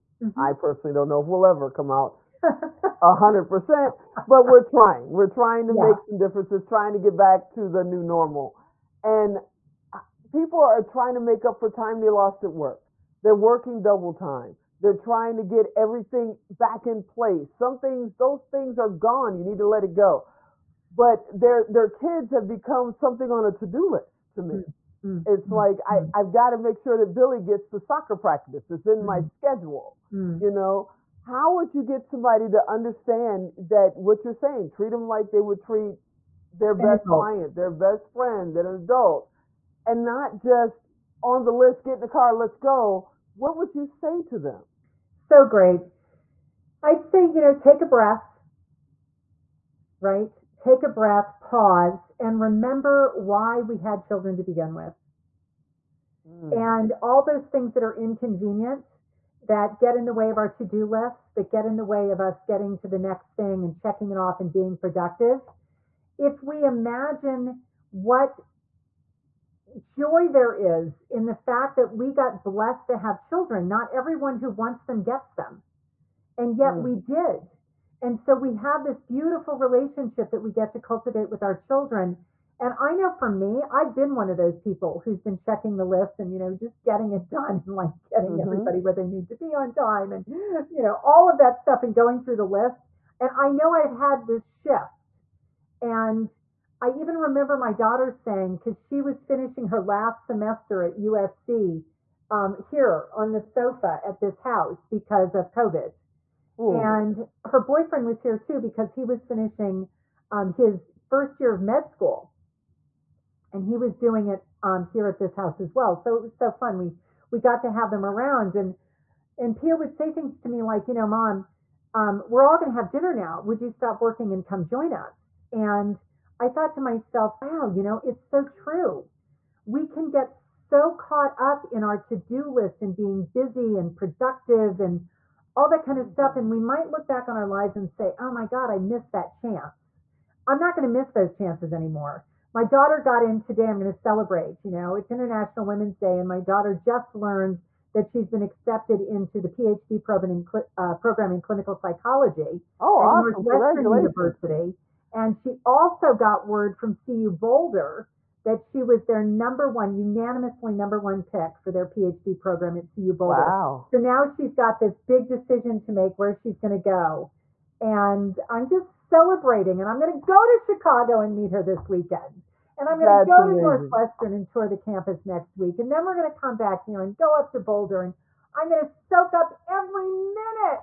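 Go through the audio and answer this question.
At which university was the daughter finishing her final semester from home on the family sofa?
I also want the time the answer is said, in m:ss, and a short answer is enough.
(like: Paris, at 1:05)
USC, at 1:40.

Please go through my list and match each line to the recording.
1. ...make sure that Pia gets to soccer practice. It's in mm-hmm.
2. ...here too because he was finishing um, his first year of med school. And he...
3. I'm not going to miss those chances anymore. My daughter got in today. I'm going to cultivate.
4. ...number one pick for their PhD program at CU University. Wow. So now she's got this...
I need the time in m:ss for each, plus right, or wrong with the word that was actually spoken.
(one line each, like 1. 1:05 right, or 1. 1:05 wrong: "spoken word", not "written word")
1. 0:26 wrong: "Billy", not "Pia"
2. 1:48 right
3. 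2:20 wrong: "celebrate", not "cultivate"
4. 2:40 wrong: "Boulder", not "University".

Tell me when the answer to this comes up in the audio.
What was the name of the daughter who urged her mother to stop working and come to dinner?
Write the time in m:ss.
1:59.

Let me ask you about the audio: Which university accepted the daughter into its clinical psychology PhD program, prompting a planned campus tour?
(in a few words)
Northwestern University.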